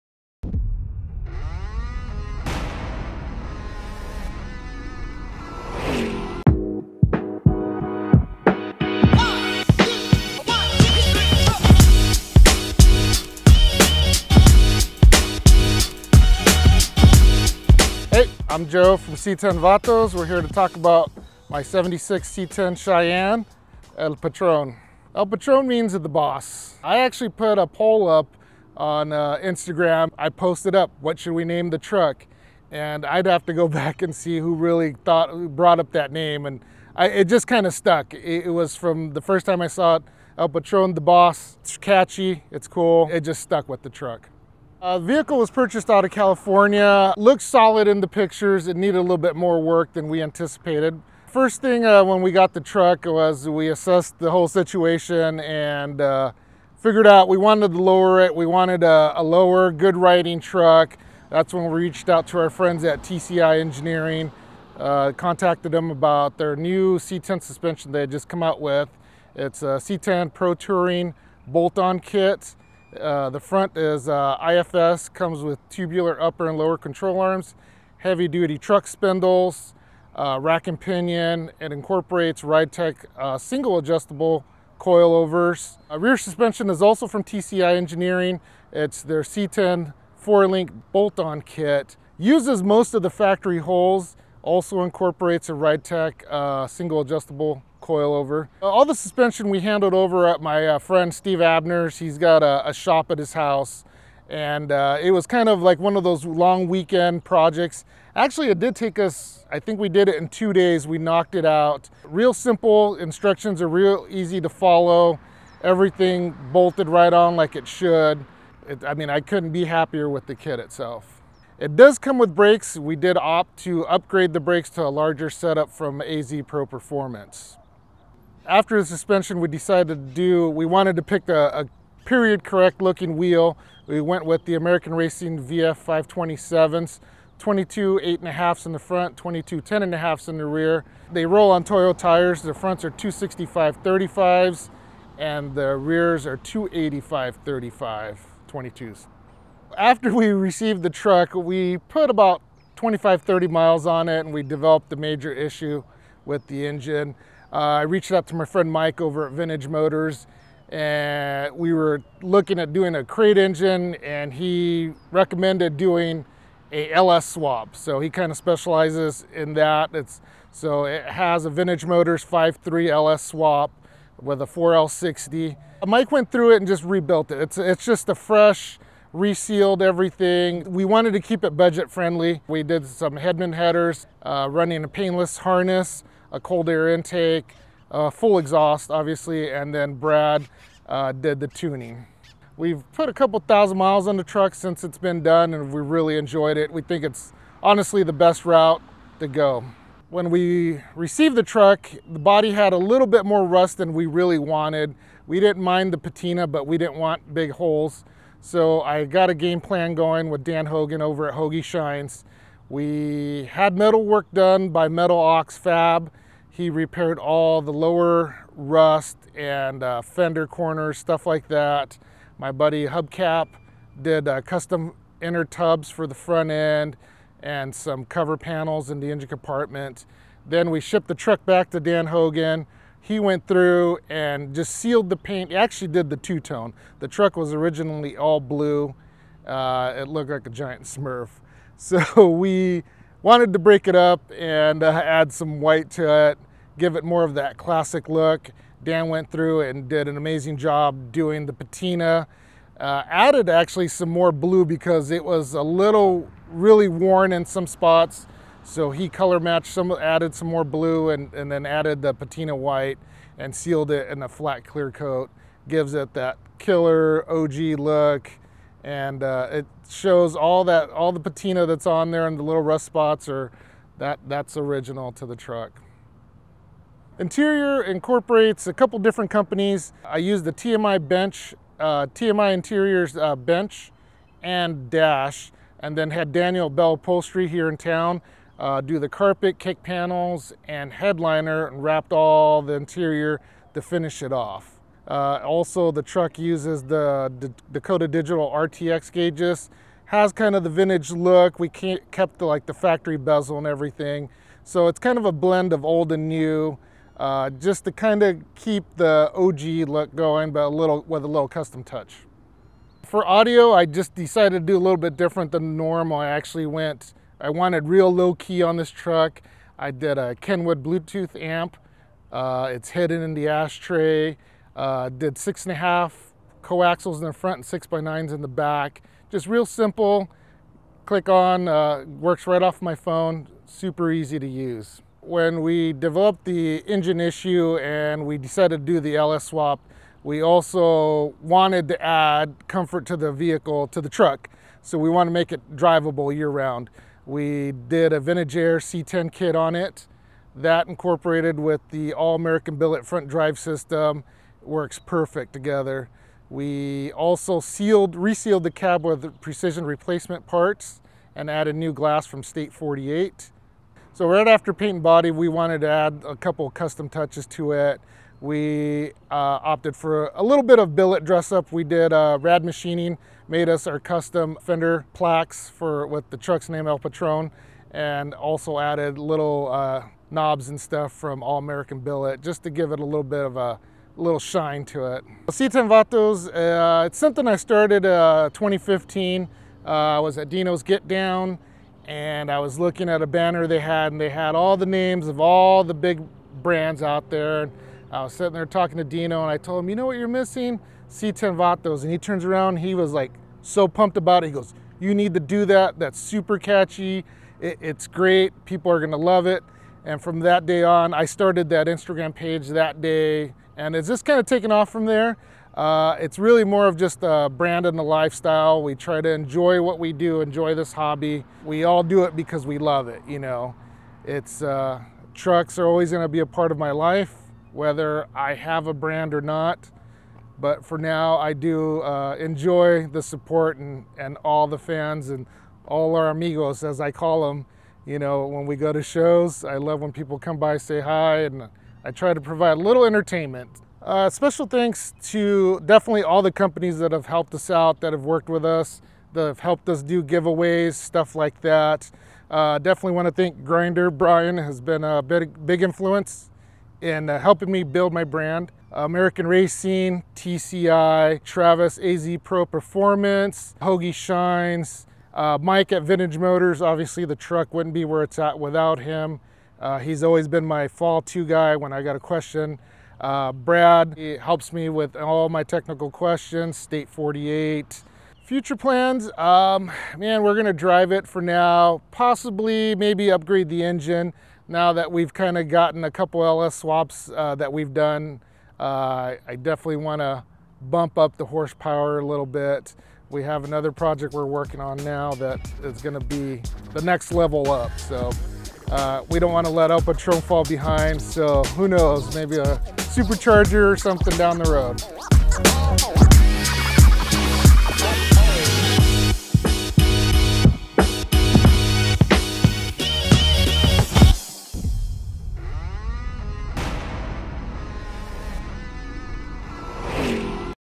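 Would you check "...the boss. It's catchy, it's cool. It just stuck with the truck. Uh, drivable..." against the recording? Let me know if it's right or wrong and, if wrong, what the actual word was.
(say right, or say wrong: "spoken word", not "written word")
wrong: "vehicle", not "drivable".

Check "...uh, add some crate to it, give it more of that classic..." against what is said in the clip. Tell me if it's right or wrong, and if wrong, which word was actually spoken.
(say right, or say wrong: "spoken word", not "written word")
wrong: "white", not "crate".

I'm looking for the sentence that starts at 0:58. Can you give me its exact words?
We wanted a, a, lower, good riding truck.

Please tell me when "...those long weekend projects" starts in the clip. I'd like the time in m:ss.
1:46.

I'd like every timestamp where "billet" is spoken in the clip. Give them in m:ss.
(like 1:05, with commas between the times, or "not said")
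5:52, 6:10, 6:21.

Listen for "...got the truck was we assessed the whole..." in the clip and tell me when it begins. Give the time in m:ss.
0:52.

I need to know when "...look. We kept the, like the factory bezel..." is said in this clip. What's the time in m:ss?
5:01.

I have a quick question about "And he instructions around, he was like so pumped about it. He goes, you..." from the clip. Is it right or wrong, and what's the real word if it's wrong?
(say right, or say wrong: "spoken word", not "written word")
wrong: "turns", not "instructions".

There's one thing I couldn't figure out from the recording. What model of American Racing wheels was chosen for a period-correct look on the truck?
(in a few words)
VF 527.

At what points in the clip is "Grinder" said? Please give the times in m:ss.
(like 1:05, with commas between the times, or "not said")
7:33.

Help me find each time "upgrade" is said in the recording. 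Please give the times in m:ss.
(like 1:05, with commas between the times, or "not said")
2:03, 8:03.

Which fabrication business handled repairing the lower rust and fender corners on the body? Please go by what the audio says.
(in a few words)
Metal Ox Fab.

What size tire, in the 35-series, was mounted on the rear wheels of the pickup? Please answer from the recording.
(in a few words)
285/35R22.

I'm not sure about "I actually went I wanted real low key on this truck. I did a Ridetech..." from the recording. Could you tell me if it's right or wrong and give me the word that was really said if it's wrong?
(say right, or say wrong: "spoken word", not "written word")
wrong: "Kenwood", not "Ridetech".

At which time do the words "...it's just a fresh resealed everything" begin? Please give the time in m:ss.
2:57.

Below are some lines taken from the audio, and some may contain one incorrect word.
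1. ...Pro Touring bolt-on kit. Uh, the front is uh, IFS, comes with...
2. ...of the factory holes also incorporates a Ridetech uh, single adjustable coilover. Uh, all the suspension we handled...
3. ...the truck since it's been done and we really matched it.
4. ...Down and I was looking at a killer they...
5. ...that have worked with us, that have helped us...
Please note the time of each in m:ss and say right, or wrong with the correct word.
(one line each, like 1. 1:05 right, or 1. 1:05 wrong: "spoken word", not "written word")
1. 1:10 right
2. 1:32 right
3. 3:14 wrong: "enjoyed", not "matched"
4. 6:31 wrong: "banner", not "killer"
5. 7:28 right.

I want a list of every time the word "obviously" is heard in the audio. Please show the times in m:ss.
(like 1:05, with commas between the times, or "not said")
3:08, 7:46.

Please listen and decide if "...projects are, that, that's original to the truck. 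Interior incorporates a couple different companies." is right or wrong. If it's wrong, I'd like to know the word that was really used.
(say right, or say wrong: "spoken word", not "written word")
wrong: "spots", not "projects".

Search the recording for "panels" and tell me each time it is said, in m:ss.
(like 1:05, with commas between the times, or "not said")
3:48, 4:49.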